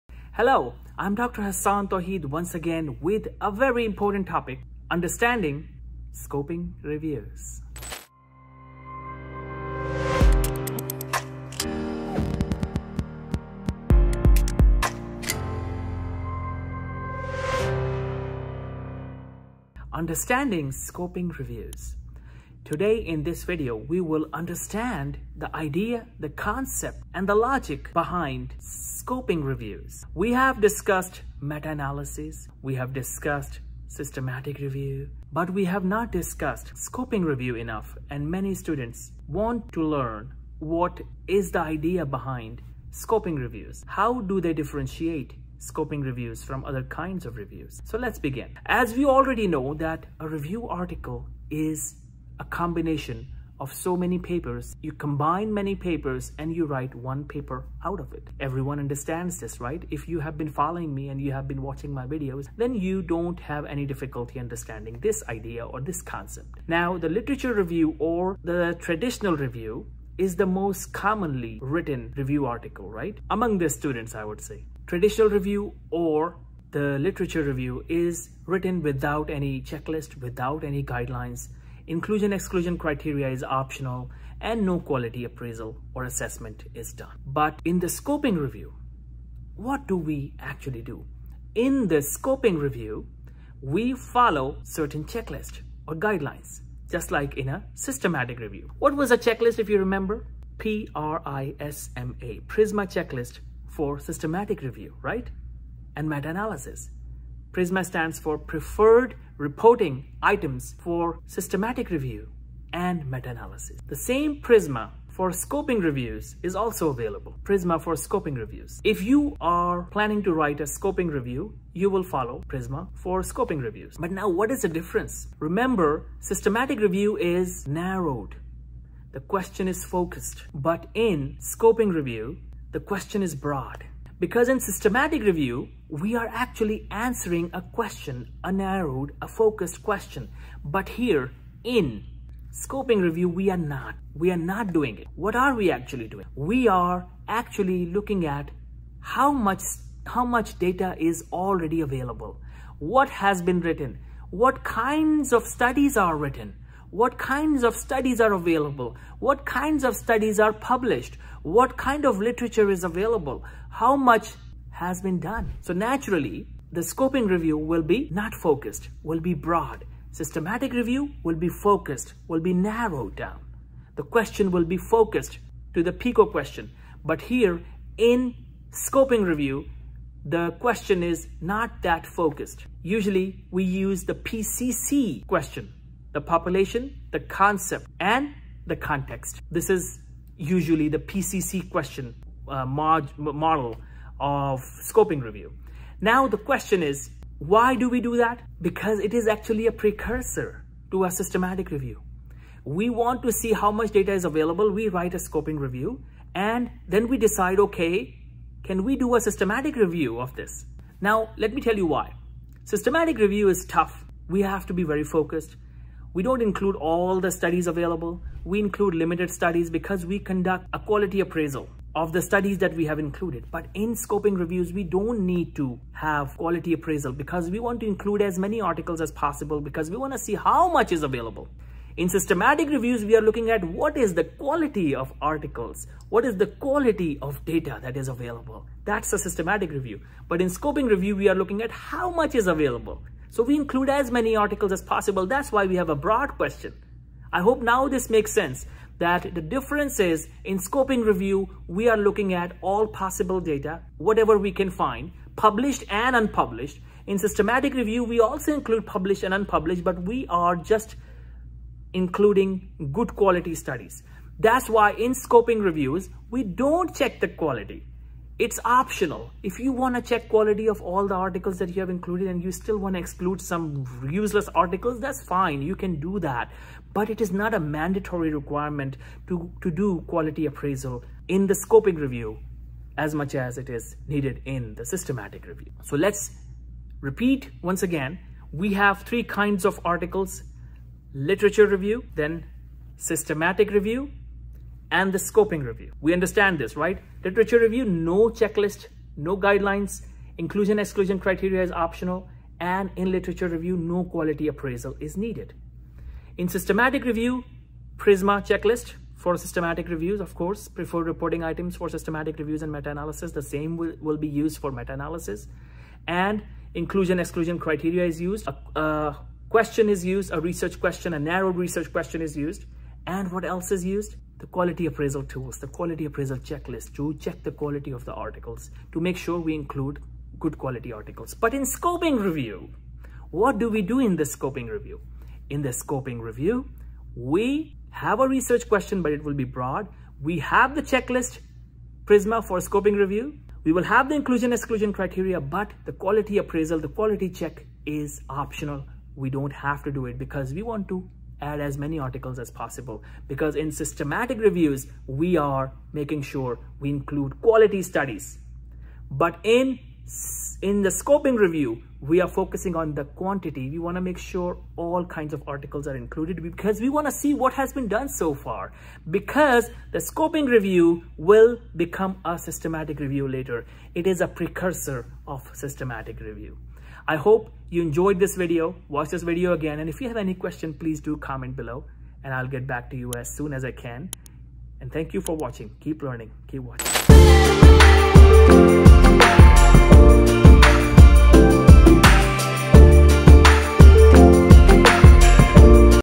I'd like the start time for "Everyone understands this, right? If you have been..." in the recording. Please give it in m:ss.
0:58.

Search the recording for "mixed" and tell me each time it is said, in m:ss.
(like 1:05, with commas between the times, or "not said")
not said.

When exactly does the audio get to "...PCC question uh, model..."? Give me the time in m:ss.
3:10.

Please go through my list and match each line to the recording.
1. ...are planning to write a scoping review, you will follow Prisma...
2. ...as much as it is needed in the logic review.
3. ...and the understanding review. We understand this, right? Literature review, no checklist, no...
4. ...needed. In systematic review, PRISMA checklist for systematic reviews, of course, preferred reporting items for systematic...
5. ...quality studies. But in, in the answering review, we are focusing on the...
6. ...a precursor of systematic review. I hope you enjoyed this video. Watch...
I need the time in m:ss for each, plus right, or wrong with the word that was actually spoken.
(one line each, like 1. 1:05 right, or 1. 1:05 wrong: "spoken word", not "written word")
1. 1:59 right
2. 4:42 wrong: "systematic", not "logic"
3. 4:54 wrong: "scoping", not "understanding"
4. 5:05 right
5. 5:57 wrong: "scoping", not "answering"
6. 6:14 right.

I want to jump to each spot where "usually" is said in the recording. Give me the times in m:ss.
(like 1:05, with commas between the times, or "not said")
3:02, 3:10.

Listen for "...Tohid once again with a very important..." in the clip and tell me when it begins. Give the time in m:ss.
0:01.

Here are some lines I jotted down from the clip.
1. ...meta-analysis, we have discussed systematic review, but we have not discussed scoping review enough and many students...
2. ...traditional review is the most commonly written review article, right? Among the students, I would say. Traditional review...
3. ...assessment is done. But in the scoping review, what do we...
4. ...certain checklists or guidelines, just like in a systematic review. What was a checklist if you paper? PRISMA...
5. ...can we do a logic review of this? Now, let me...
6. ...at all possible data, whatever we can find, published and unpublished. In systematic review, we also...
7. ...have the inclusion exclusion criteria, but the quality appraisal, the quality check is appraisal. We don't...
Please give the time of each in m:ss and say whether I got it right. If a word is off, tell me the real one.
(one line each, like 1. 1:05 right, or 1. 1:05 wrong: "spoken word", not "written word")
1. 0:31 right
2. 1:08 right
3. 1:26 right
4. 1:34 wrong: "remember", not "paper"
5. 3:28 wrong: "systematic", not "logic"
6. 4:12 right
7. 5:43 wrong: "optional", not "appraisal".